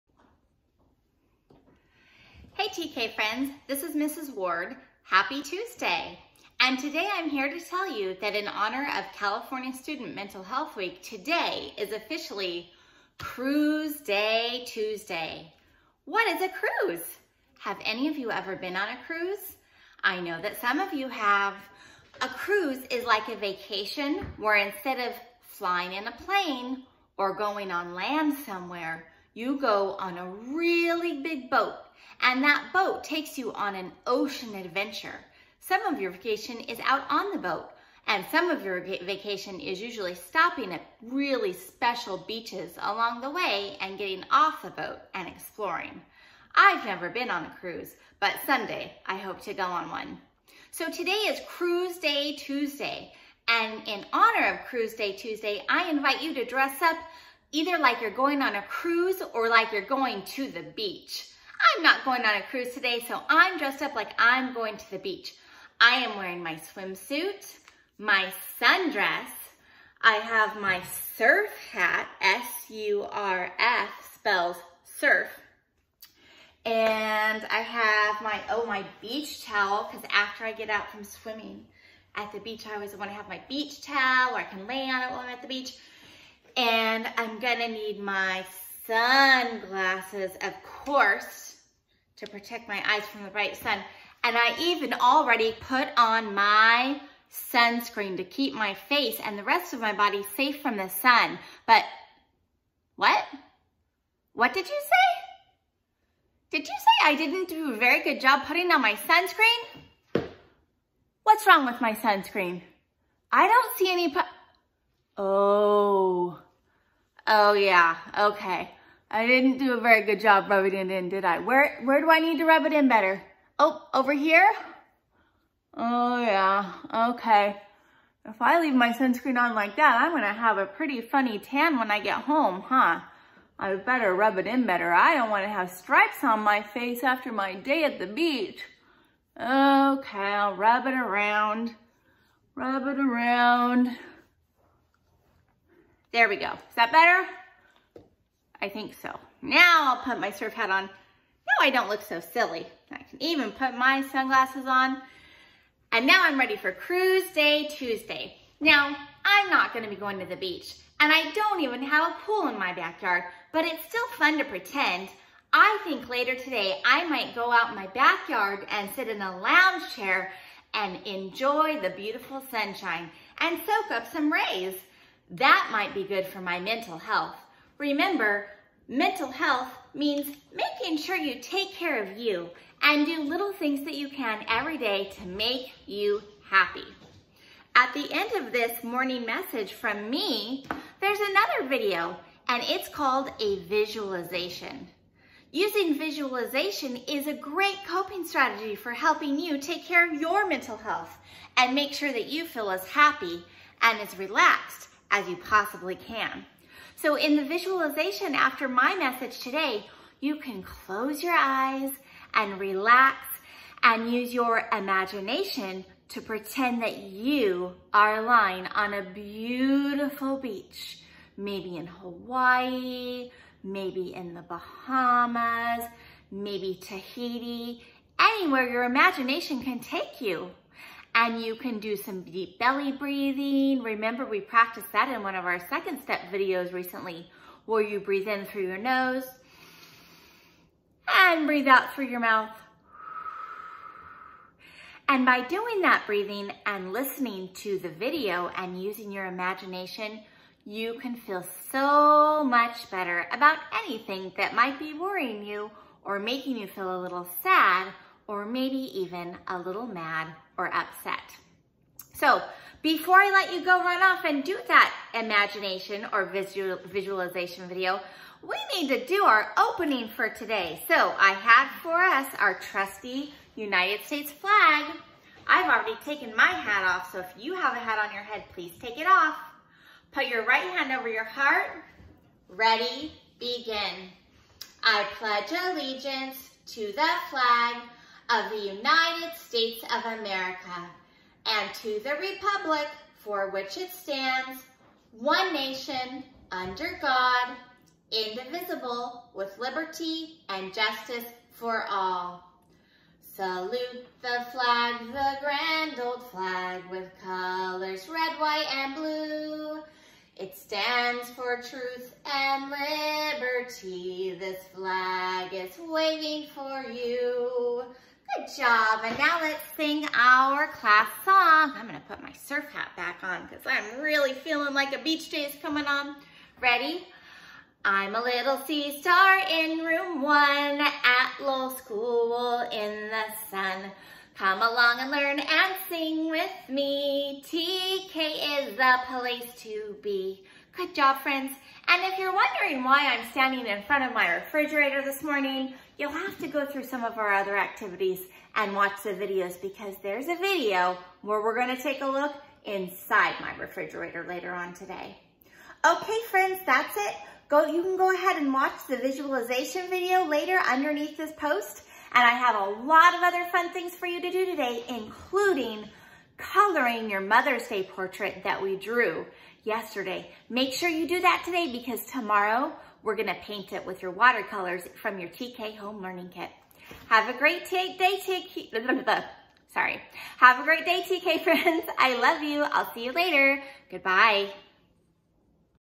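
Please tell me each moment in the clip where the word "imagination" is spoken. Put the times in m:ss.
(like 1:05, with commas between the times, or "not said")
3:34, 3:48, 4:09, 4:25.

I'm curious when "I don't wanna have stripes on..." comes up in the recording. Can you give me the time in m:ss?
2:14.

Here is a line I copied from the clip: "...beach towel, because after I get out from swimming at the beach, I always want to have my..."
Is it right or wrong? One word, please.
right.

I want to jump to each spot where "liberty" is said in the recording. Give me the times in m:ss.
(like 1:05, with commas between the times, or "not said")
4:59, 5:12.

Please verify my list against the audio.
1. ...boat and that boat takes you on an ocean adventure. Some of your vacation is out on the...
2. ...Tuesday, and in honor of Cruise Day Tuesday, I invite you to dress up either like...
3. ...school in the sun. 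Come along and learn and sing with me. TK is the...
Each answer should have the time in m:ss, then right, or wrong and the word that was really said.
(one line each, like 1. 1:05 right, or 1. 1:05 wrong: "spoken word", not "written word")
1. 0:31 right
2. 0:52 right
3. 5:31 right.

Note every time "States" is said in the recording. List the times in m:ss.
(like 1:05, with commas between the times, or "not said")
4:34, 4:49.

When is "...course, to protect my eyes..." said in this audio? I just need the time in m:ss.
1:30.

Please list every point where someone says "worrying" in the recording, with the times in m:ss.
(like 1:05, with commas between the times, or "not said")
4:14.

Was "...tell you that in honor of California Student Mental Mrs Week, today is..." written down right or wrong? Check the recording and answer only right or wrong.
wrong.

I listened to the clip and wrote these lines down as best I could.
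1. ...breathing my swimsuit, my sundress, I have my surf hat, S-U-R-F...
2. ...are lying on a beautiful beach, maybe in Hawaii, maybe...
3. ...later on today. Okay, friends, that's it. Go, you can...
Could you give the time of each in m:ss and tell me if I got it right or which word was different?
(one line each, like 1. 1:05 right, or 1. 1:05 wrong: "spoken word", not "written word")
1. 1:06 wrong: "wearing", not "breathing"
2. 3:37 right
3. 5:54 right.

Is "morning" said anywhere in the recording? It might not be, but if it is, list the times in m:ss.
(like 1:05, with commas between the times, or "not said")
3:08, 5:45.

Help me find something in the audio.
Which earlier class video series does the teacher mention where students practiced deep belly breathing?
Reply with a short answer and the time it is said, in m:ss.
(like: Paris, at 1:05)
Second Step, at 3:55.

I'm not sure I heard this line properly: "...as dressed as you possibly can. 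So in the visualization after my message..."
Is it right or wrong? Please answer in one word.
wrong.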